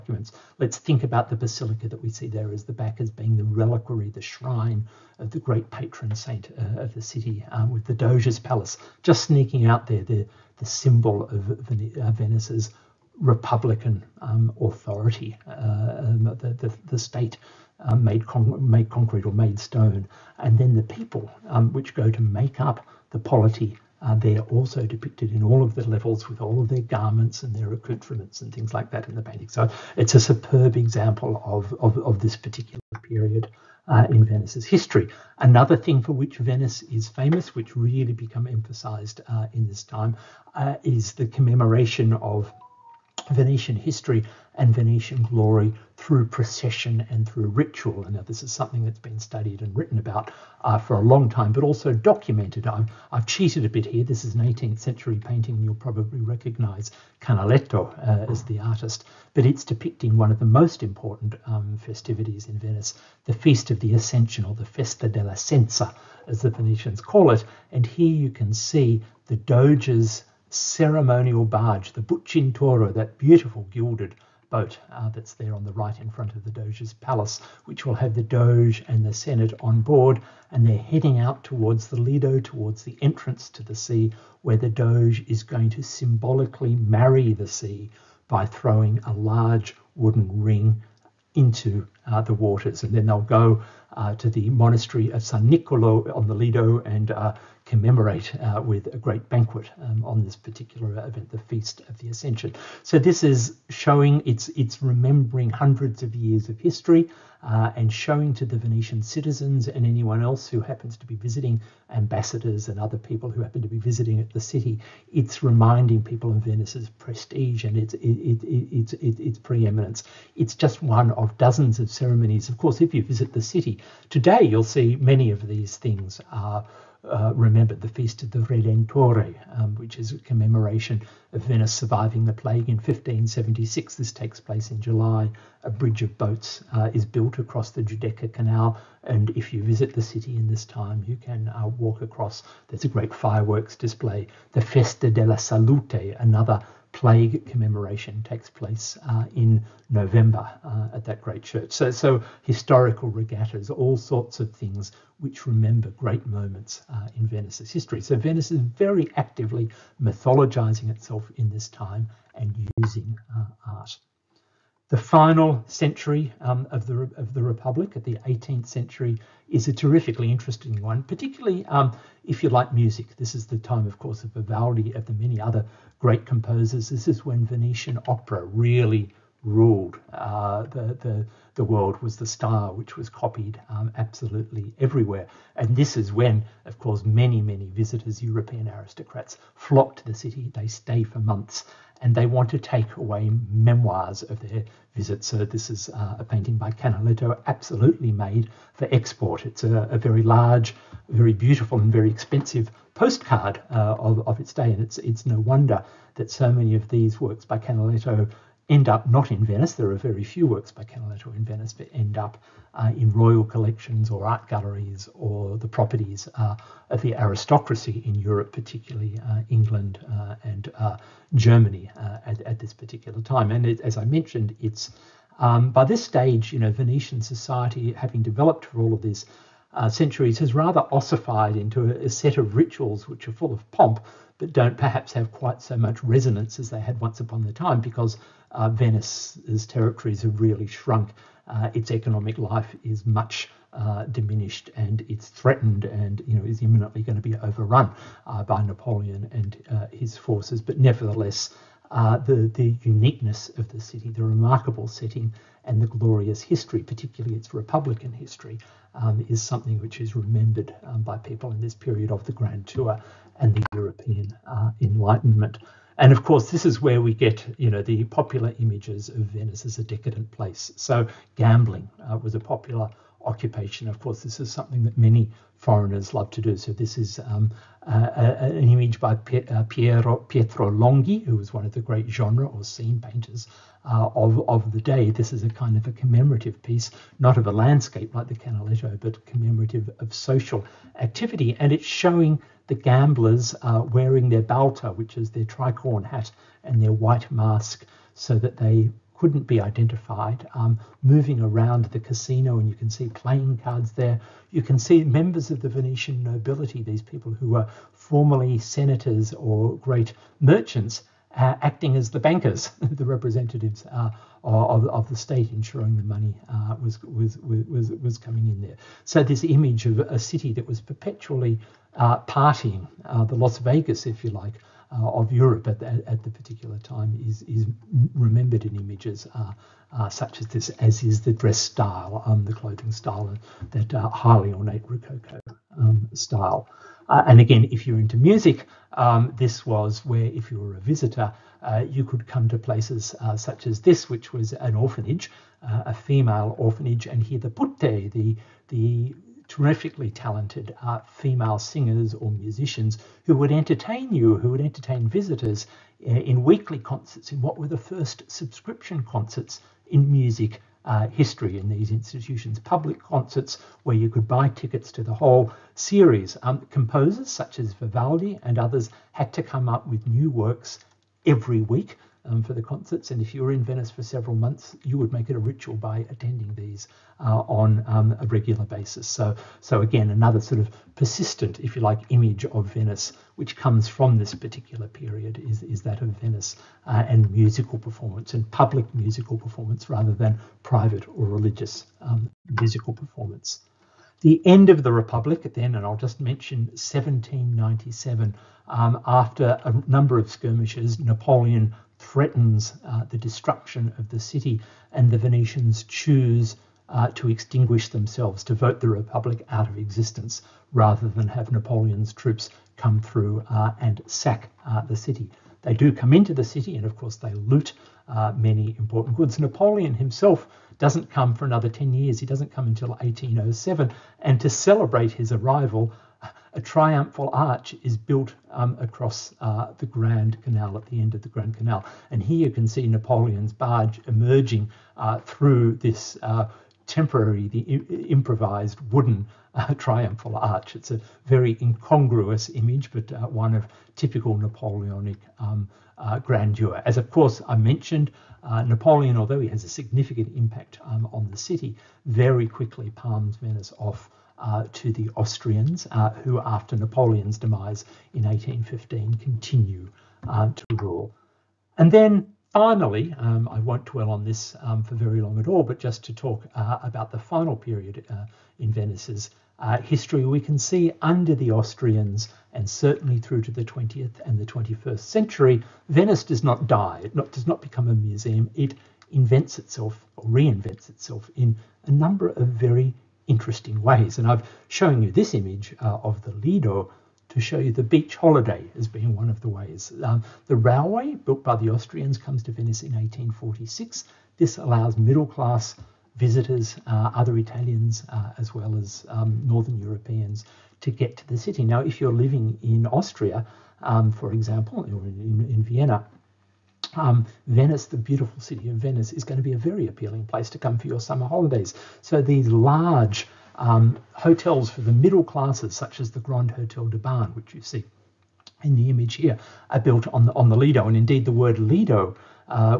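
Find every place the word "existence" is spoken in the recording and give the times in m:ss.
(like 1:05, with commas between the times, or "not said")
6:49.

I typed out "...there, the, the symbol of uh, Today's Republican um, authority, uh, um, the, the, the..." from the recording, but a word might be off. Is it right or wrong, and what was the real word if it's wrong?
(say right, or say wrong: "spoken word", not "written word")
wrong: "Venice", not "Today".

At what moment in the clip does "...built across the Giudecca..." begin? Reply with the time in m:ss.
2:17.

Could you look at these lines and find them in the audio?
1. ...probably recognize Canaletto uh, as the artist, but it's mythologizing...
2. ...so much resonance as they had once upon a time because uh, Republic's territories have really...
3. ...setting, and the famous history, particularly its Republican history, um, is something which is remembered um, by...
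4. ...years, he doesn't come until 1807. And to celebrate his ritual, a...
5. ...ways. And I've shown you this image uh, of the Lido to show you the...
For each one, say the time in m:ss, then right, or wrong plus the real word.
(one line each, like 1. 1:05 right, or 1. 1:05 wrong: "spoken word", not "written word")
1. 0:55 wrong: "depicting", not "mythologizing"
2. 3:55 wrong: "Venice", not "Republic"
3. 4:14 wrong: "glorious", not "famous"
4. 7:01 wrong: "arrival", not "ritual"
5. 8:03 right.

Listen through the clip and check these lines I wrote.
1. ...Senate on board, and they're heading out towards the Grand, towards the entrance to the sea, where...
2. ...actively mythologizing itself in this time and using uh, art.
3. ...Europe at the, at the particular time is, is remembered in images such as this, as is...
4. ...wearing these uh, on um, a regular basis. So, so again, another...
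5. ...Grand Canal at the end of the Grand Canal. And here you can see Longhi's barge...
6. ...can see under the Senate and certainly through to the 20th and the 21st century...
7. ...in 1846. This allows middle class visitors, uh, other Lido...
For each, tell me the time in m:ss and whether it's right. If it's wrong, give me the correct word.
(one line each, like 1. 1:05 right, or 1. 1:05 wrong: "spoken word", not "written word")
1. 1:19 wrong: "Lido", not "Grand"
2. 2:39 right
3. 5:25 right
4. 6:16 wrong: "attending", not "wearing"
5. 7:09 wrong: "Napoleon", not "Longhi"
6. 7:50 wrong: "Austrians", not "Senate"
7. 8:12 wrong: "Italians", not "Lido".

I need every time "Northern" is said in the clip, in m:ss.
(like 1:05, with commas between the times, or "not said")
8:19.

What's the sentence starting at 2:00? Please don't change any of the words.
It's just one of dozens of ceremonies.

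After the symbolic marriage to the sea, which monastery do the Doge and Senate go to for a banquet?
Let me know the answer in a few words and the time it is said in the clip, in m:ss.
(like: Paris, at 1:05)
San Nicolo, at 1:35.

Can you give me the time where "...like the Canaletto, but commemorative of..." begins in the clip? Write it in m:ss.
4:48.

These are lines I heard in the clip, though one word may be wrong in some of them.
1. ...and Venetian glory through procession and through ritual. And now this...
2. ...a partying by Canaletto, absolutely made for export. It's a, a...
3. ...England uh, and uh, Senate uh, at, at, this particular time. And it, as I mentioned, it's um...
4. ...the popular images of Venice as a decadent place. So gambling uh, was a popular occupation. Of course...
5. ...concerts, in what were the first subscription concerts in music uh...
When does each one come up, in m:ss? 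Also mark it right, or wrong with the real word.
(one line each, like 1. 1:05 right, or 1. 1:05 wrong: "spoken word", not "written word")
1. 0:44 right
2. 3:16 wrong: "painting", not "partying"
3. 3:39 wrong: "Germany", not "Senate"
4. 4:27 right
5. 5:56 right.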